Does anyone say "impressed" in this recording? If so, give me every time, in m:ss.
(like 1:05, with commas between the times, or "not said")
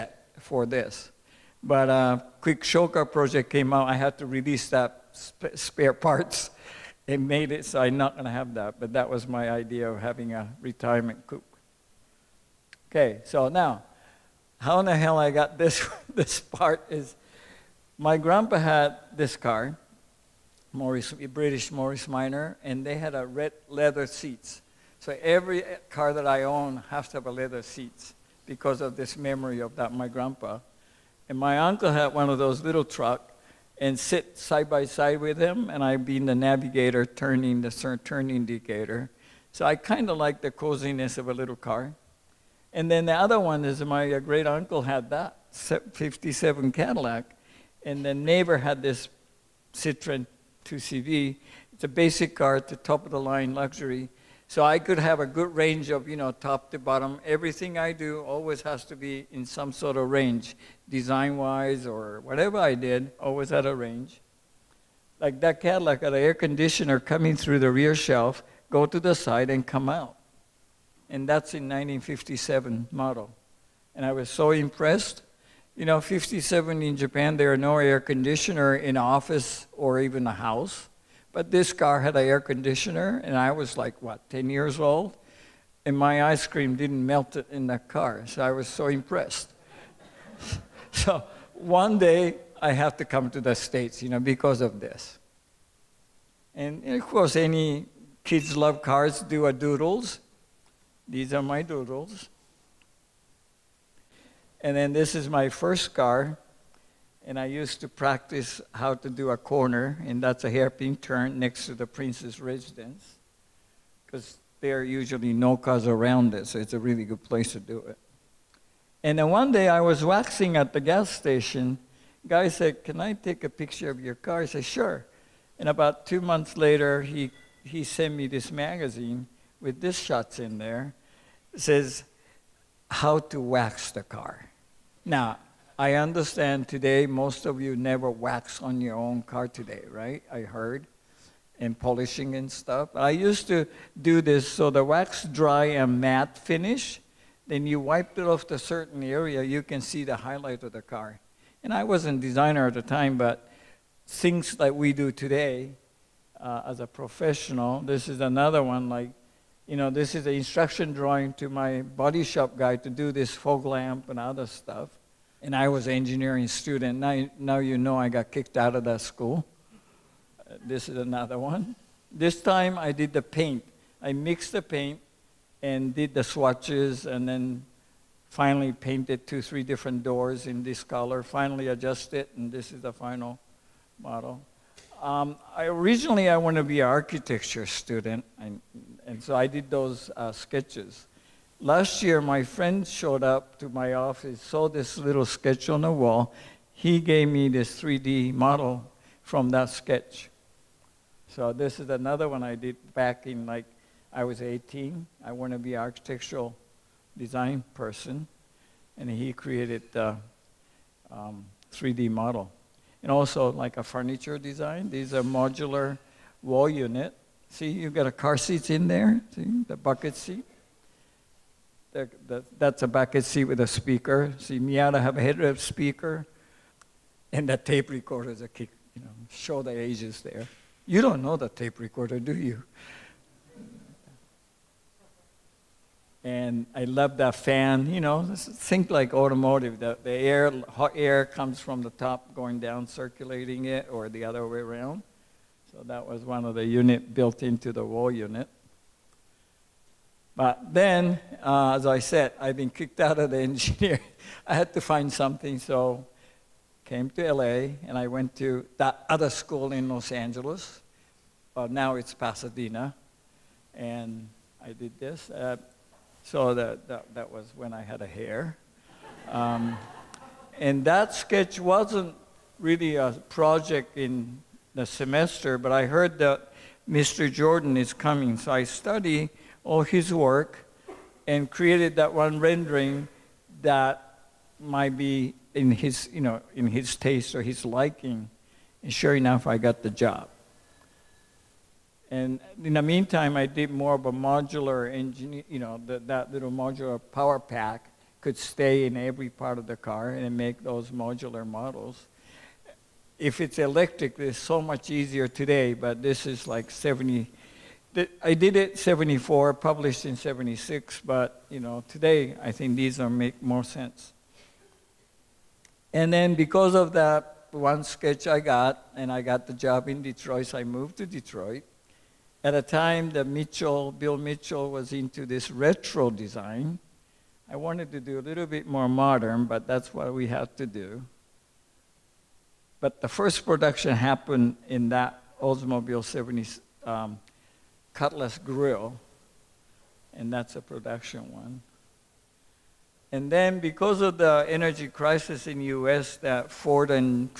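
1:14, 1:28.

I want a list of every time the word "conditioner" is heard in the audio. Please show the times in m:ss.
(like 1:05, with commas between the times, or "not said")
1:06, 1:18, 1:22.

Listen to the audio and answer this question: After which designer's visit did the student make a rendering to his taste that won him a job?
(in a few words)
Mr. Jordan.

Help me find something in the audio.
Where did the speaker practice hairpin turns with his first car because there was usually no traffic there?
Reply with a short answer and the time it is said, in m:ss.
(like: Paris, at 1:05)
Prince's residence, at 1:51.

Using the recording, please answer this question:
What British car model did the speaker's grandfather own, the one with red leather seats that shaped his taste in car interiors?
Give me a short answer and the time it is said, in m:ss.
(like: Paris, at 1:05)
Morris Minor, at 0:21.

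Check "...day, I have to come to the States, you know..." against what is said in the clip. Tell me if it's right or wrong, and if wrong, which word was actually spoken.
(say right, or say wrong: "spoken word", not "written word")
right.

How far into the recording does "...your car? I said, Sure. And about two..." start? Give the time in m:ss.
2:03.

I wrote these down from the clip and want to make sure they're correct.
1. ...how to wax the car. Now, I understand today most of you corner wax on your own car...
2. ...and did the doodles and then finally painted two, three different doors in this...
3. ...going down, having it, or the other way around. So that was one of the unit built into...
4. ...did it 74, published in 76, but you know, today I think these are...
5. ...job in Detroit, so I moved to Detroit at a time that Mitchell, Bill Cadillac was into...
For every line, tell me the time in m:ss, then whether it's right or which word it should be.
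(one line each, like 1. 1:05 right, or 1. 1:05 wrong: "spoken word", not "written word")
1. 2:12 wrong: "never", not "corner"
2. 2:55 wrong: "swatches", not "doodles"
3. 4:02 wrong: "circulating", not "having"
4. 5:08 right
5. 5:19 wrong: "Mitchell", not "Cadillac".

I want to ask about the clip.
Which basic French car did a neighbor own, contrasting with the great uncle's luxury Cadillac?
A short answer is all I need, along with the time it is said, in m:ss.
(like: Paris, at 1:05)
Citroen 2CV, at 0:49.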